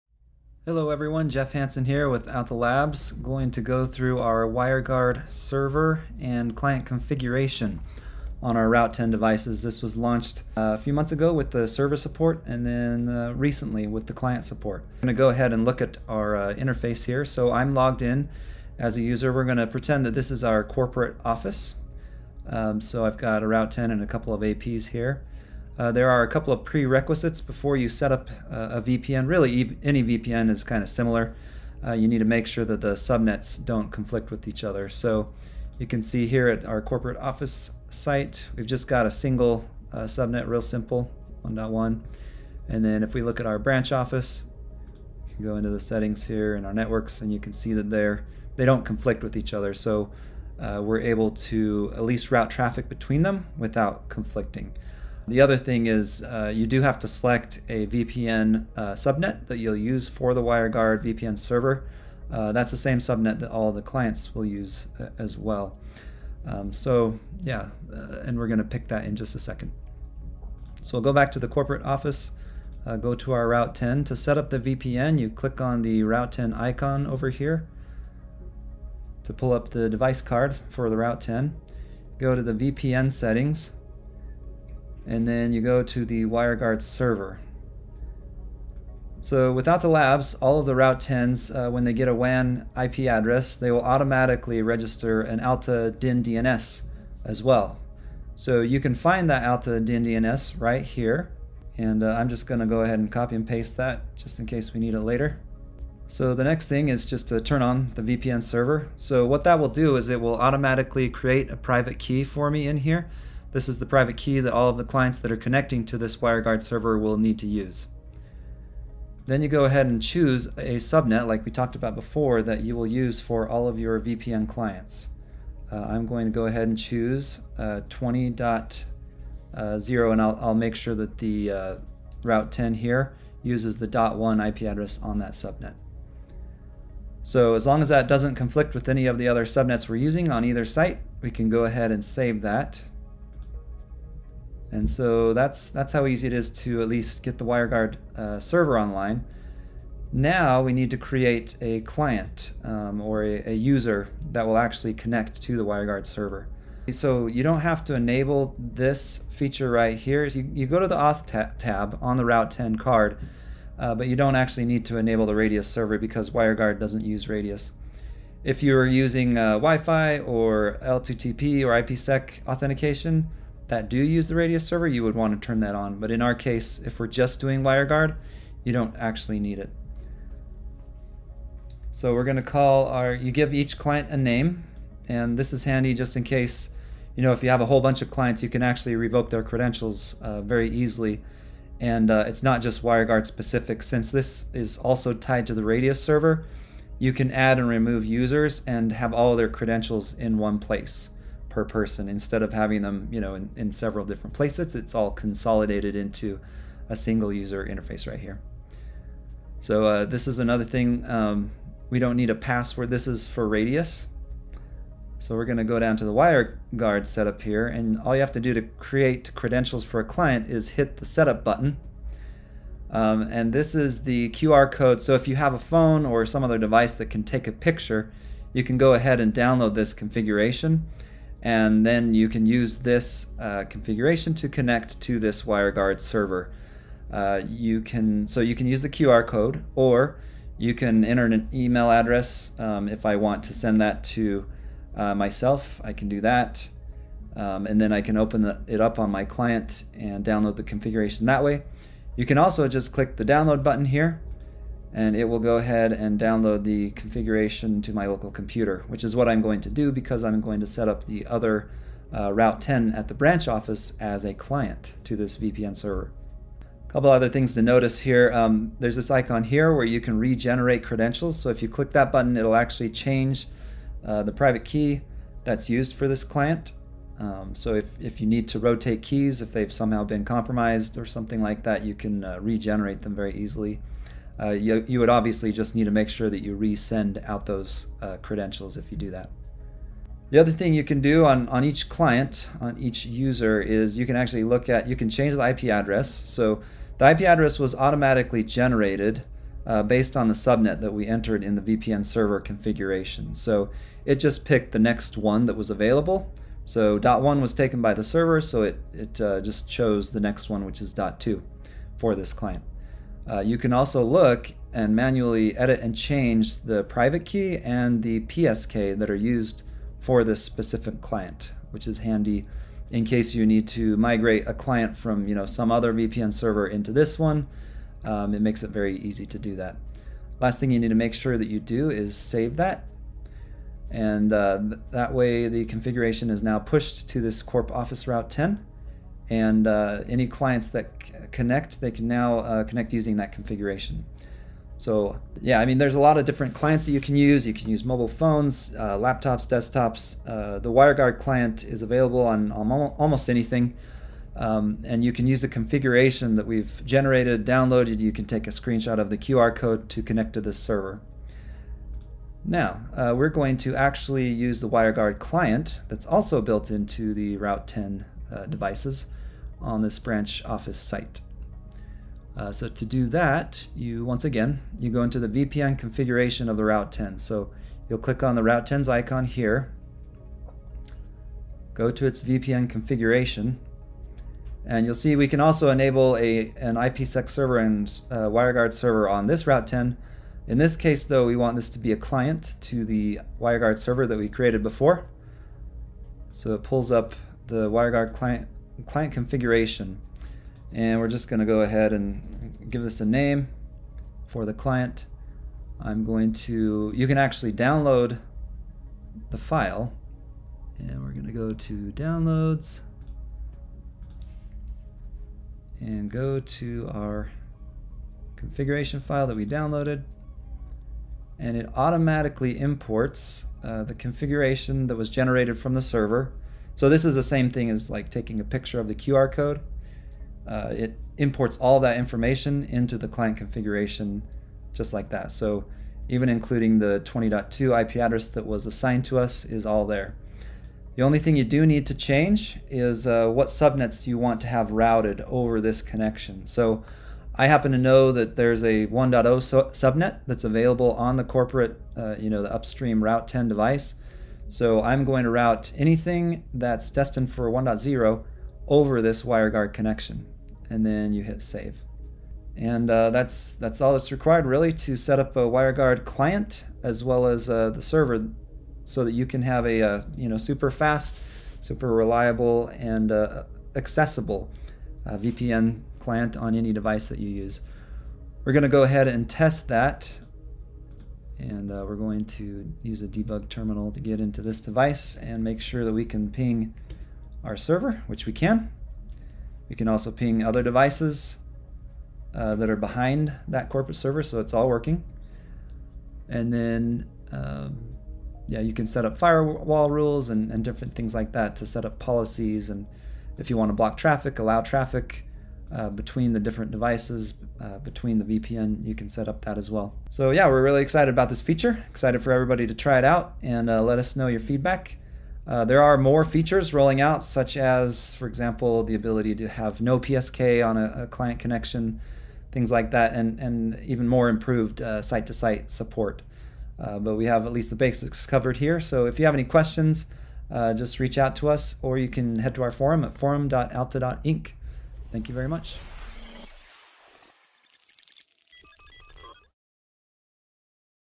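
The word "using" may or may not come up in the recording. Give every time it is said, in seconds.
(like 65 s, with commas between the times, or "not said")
139 s, 168 s, 342 s.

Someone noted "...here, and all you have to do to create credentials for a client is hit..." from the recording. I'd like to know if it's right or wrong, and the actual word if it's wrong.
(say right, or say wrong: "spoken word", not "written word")
right.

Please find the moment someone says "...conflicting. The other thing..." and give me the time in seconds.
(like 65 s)
54 s.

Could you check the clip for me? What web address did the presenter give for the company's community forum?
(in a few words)
forum.alta.inc.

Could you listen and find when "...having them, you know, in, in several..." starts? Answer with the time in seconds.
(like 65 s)
202 s.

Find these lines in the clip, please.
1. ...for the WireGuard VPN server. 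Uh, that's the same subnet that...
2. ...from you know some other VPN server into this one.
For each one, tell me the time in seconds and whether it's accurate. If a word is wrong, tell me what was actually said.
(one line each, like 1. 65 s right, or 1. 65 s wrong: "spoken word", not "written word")
1. 60 s right
2. 324 s right.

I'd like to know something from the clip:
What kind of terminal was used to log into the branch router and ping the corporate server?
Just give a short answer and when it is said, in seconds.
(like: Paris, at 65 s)
debug terminal, at 483 s.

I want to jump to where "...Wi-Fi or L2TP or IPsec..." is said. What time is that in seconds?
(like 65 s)
169 s.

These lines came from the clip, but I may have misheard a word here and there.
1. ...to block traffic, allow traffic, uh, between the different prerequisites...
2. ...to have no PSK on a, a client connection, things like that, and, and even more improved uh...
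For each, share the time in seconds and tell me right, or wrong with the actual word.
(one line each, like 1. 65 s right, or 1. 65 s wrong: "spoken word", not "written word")
1. 503 s wrong: "devices", not "prerequisites"
2. 519 s right.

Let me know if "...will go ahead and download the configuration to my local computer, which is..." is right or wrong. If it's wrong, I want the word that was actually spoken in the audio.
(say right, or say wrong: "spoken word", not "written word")
right.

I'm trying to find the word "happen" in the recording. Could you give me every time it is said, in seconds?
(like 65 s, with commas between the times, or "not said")
447 s.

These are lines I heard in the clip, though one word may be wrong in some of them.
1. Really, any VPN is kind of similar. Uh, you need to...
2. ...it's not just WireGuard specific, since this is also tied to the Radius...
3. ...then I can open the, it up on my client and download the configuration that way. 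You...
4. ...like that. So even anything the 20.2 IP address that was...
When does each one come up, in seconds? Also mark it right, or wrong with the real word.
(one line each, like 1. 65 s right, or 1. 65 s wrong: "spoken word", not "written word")
1. 29 s right
2. 192 s right
3. 247 s right
4. 434 s wrong: "including", not "anything".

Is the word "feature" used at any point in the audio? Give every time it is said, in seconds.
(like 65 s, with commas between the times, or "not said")
159 s, 511 s, 516 s.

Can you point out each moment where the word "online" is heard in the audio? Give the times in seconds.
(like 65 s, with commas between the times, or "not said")
148 s.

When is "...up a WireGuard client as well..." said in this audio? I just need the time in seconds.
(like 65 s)
465 s.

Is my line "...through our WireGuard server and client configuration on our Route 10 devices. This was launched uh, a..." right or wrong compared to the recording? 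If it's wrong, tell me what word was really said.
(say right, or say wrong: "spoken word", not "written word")
right.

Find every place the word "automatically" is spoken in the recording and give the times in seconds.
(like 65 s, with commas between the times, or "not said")
93 s, 110 s, 297 s, 421 s.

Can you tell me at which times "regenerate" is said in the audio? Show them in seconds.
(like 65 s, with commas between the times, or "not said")
270 s, 282 s.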